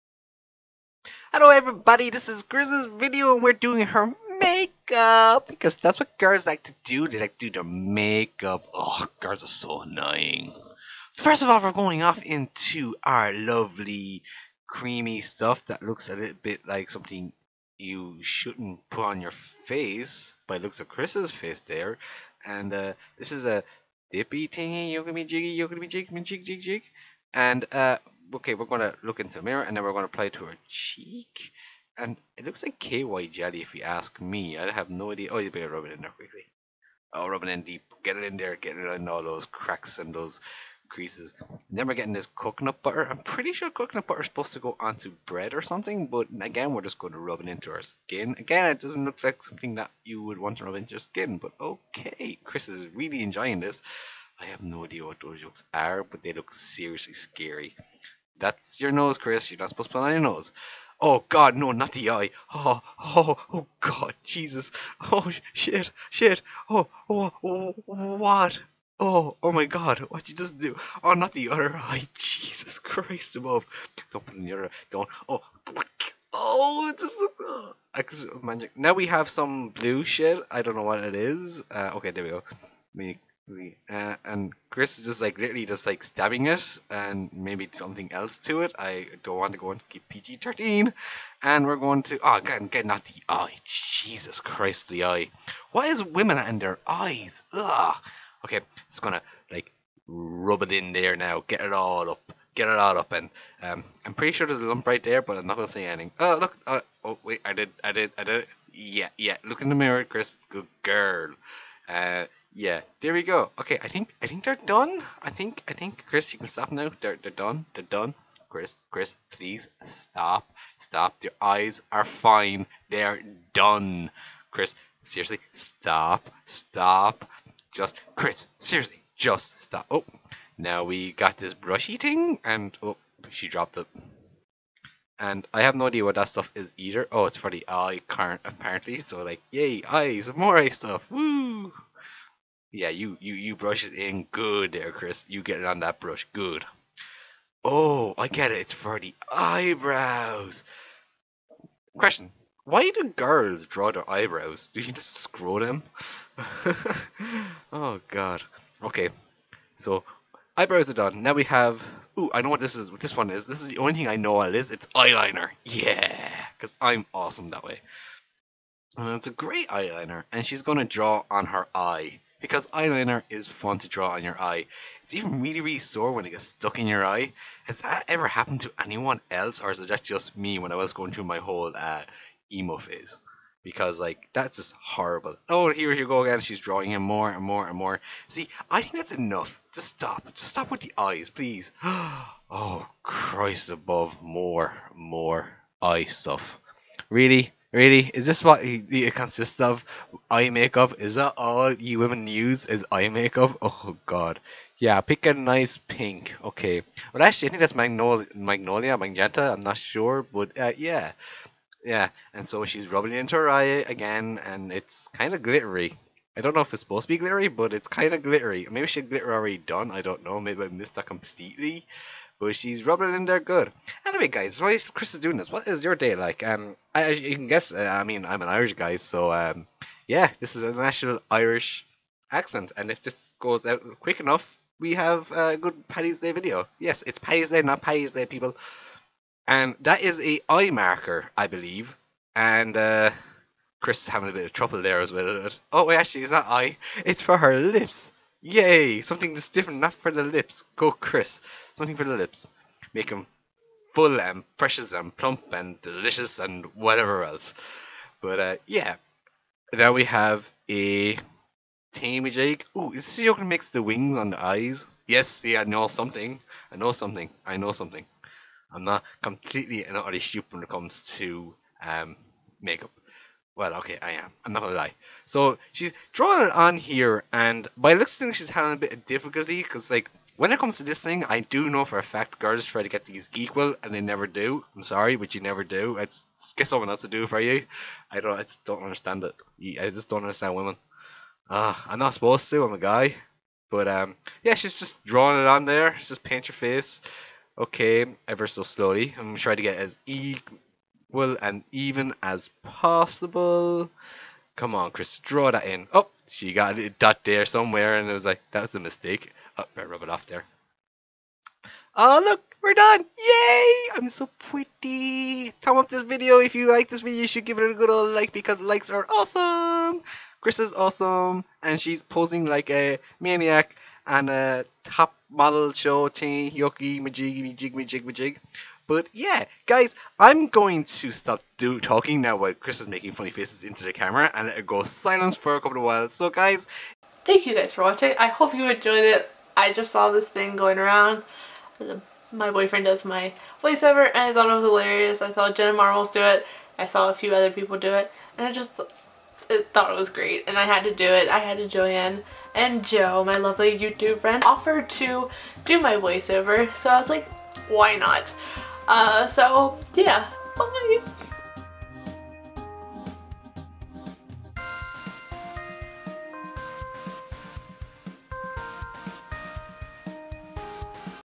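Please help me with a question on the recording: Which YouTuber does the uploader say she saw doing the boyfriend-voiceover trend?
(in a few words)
Jenna Marbles.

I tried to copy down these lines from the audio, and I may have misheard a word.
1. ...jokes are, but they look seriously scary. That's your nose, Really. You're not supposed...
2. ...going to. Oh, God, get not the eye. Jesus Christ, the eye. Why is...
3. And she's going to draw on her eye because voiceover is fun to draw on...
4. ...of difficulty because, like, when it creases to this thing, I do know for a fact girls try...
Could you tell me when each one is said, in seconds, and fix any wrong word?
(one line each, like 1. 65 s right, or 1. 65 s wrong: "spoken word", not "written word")
1. 55 s wrong: "Chris", not "Really"
2. 91 s right
3. 170 s wrong: "eyeliner", not "voiceover"
4. 278 s wrong: "comes", not "creases".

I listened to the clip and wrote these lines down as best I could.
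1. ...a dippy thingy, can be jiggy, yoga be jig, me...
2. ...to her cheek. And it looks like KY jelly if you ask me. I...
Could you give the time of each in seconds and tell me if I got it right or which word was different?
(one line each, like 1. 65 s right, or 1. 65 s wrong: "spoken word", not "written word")
1. 23 s right
2. 30 s right.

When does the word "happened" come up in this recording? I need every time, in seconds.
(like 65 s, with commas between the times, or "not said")
178 s.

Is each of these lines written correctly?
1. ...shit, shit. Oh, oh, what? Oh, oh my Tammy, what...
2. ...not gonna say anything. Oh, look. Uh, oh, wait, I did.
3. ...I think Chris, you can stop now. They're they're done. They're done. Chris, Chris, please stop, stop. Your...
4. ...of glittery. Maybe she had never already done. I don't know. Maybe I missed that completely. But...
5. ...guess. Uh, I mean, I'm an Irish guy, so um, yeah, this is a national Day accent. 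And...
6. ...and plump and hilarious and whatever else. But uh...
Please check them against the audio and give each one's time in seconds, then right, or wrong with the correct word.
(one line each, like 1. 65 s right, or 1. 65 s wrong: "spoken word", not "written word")
1. 65 s wrong: "God", not "Tammy"
2. 105 s right
3. 115 s right
4. 218 s wrong: "glitter", not "never"
5. 227 s wrong: "Irish", not "Day"
6. 254 s wrong: "delicious", not "hilarious".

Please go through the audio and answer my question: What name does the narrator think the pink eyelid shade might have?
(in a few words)
Magnolia Magenta.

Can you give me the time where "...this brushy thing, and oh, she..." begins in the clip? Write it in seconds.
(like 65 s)
131 s.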